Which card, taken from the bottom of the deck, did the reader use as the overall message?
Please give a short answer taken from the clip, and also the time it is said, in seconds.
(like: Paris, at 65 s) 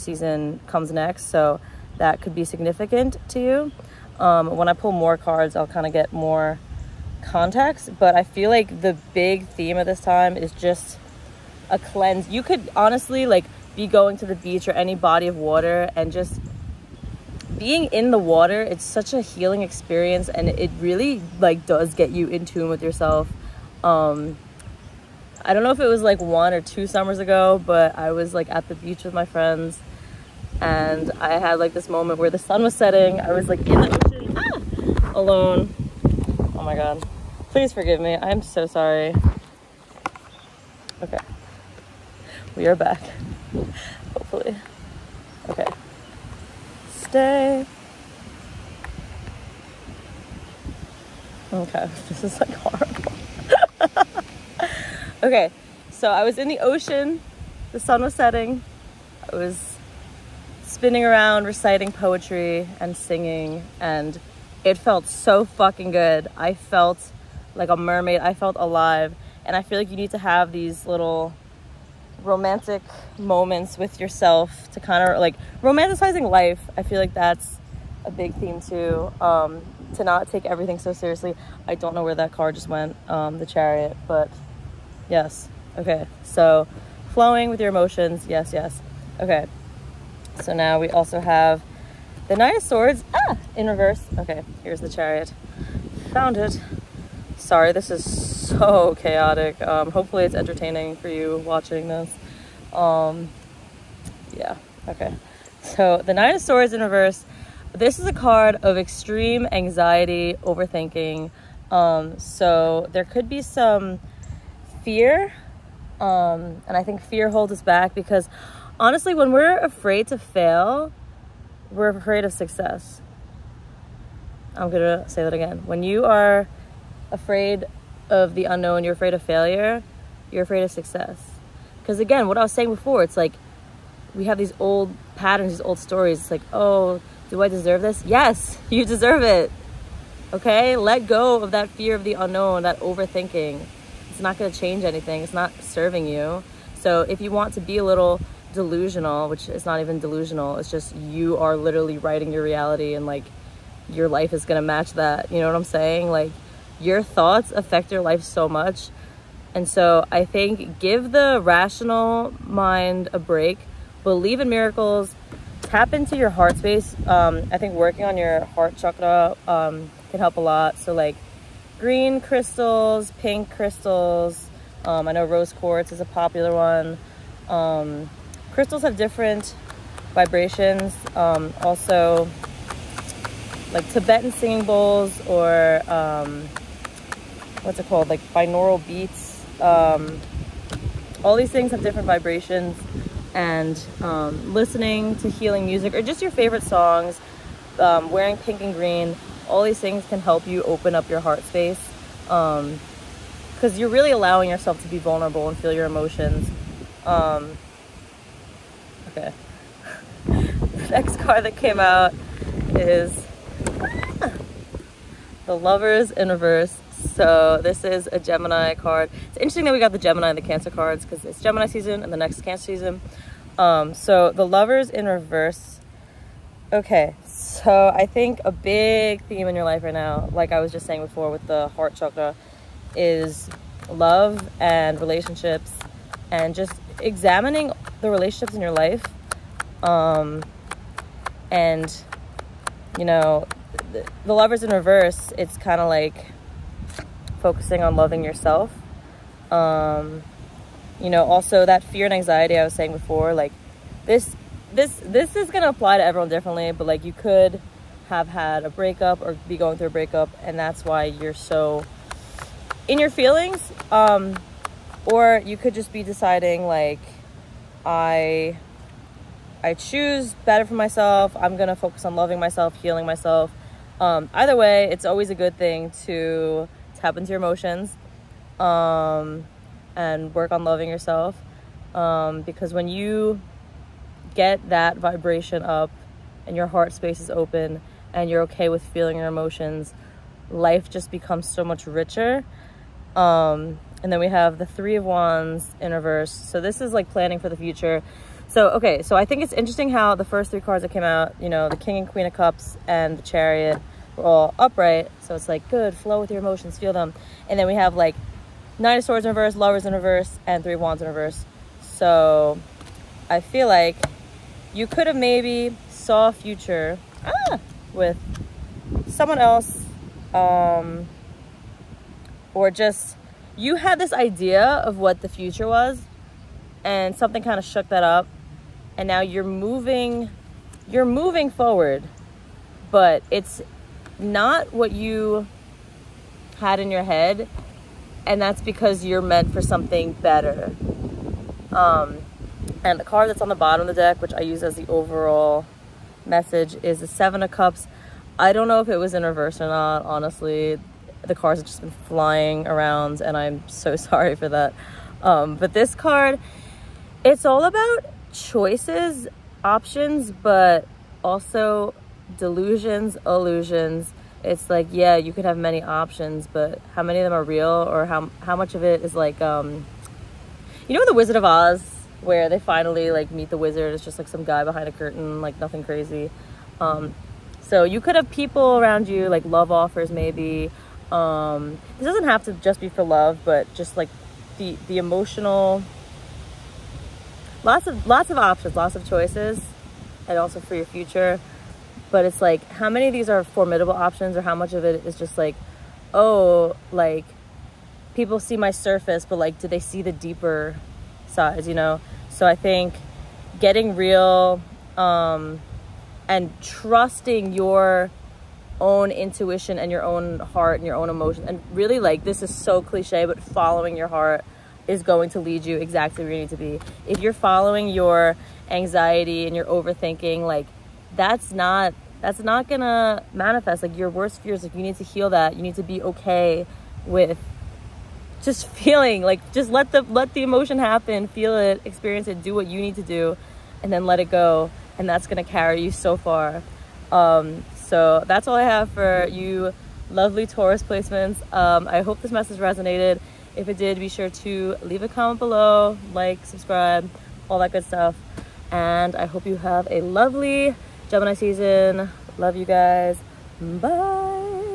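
Seven of Cups, at 346 s.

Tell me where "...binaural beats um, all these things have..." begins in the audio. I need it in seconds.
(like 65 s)
188 s.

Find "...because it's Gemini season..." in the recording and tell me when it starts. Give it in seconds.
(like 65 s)
221 s.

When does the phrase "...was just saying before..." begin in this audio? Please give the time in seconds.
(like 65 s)
230 s.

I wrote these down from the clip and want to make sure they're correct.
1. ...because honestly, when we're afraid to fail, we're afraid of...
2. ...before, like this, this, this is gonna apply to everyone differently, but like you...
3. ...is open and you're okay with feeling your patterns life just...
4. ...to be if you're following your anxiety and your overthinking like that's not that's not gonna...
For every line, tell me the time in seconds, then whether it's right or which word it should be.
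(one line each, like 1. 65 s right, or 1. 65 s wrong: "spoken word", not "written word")
1. 117 s right
2. 252 s right
3. 287 s wrong: "emotions", not "patterns"
4. 416 s right.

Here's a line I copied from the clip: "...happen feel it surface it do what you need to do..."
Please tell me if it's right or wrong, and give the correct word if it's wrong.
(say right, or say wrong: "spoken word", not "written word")
wrong: "experience", not "surface".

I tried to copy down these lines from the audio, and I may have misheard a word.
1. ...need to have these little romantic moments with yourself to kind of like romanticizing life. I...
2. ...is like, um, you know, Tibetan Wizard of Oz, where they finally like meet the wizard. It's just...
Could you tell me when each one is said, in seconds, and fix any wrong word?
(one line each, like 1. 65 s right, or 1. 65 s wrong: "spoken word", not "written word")
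1. 69 s right
2. 369 s wrong: "The", not "Tibetan".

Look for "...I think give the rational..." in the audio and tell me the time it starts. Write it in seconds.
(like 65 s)
160 s.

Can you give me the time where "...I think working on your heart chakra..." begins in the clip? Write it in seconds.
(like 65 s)
167 s.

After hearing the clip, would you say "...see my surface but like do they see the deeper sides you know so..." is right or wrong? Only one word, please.
right.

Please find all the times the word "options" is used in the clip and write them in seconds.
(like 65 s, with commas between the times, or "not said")
359 s, 365 s, 388 s, 393 s.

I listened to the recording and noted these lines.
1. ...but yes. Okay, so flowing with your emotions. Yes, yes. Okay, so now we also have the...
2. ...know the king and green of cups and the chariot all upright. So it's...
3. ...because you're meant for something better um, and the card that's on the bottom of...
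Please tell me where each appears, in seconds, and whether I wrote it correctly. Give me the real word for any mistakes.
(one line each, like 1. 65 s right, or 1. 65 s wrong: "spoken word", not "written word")
1. 84 s right
2. 301 s wrong: "queen", not "green"
3. 338 s right.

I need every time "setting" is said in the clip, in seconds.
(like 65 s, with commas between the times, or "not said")
32 s, 58 s.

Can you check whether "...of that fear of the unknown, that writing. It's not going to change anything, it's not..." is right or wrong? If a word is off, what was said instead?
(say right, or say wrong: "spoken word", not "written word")
wrong: "overthinking", not "writing".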